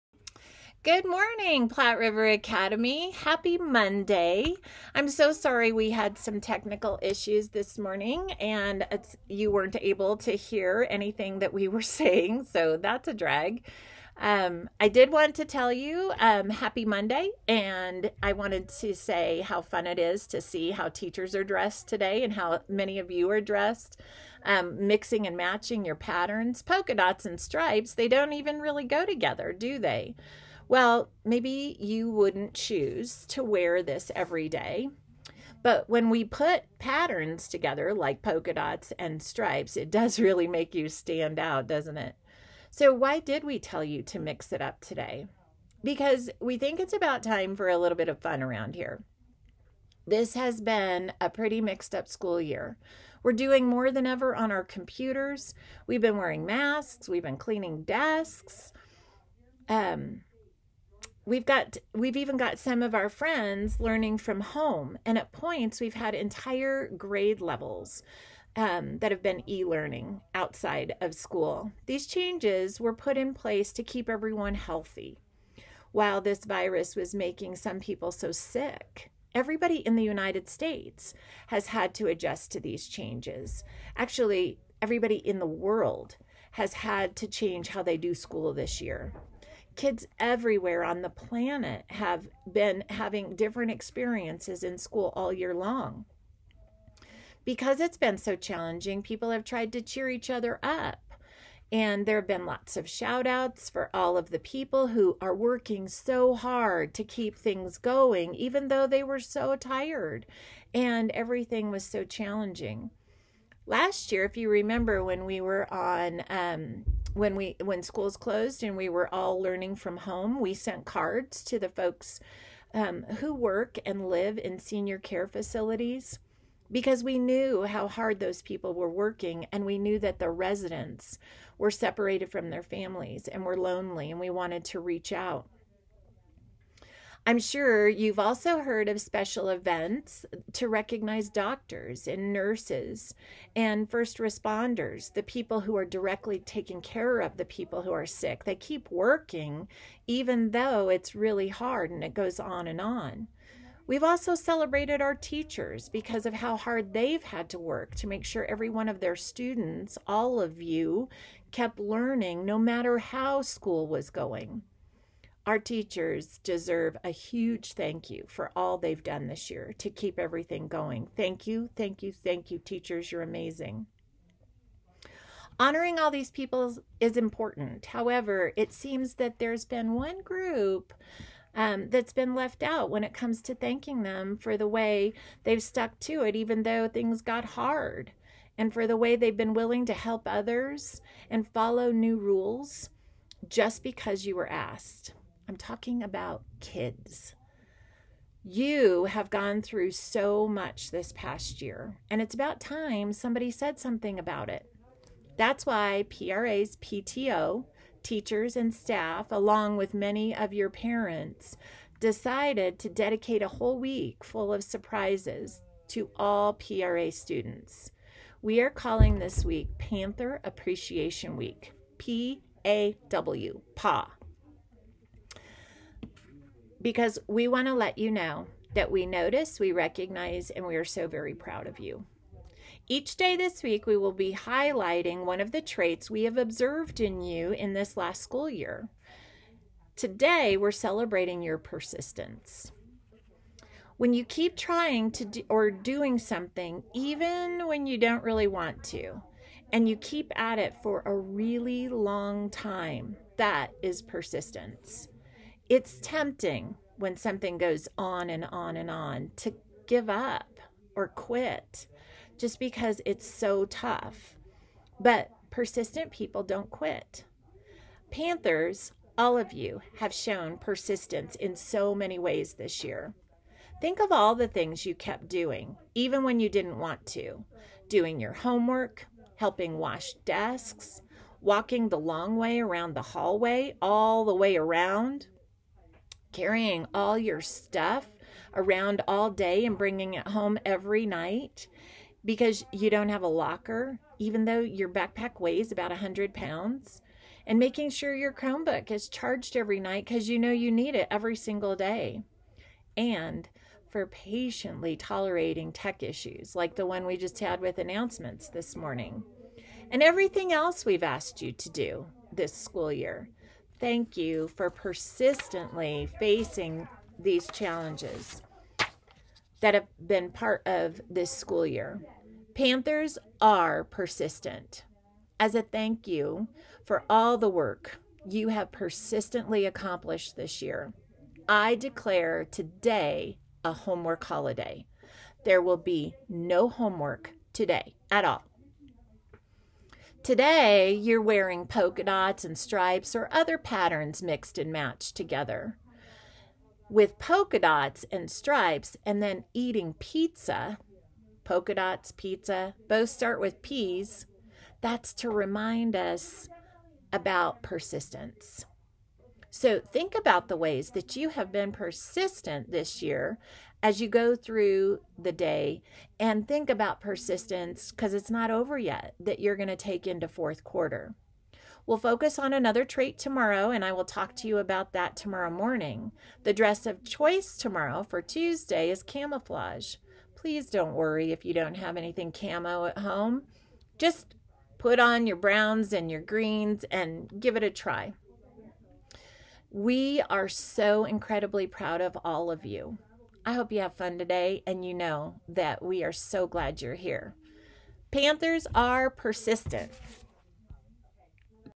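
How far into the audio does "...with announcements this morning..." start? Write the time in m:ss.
5:07.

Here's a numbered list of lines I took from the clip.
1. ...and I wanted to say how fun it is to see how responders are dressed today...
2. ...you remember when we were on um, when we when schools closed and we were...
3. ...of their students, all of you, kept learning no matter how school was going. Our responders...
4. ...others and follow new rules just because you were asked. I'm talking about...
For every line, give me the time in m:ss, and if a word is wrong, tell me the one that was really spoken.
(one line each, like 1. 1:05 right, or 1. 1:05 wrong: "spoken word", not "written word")
1. 0:17 wrong: "teachers", not "responders"
2. 1:54 right
3. 2:38 wrong: "teachers", not "responders"
4. 3:10 right.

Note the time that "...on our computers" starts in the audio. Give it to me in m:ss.
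0:54.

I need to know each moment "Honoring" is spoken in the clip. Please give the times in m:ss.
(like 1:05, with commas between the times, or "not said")
2:55.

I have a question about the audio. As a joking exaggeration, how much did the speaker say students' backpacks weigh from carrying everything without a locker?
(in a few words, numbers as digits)
100 pounds.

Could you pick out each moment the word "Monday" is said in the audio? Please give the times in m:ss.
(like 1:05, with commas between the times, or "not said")
0:03, 0:16.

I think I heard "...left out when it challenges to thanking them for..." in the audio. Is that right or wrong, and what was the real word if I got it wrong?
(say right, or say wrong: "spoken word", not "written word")
wrong: "comes", not "challenges".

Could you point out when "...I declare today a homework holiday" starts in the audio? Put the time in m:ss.
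5:31.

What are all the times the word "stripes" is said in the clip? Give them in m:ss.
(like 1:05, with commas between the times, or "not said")
0:27, 0:39, 5:42, 5:48.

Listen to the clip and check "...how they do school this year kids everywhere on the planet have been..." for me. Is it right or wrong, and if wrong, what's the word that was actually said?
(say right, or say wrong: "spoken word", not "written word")
right.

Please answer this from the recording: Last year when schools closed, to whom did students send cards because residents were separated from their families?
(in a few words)
senior care facilities.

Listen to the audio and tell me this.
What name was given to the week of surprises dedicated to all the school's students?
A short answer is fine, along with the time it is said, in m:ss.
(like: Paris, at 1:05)
Panther Appreciation Week, at 3:39.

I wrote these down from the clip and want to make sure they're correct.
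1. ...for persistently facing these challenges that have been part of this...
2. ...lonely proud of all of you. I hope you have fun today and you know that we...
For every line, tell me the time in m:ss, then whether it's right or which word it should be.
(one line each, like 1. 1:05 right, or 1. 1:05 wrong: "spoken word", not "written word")
1. 5:14 right
2. 6:31 wrong: "incredibly", not "lonely".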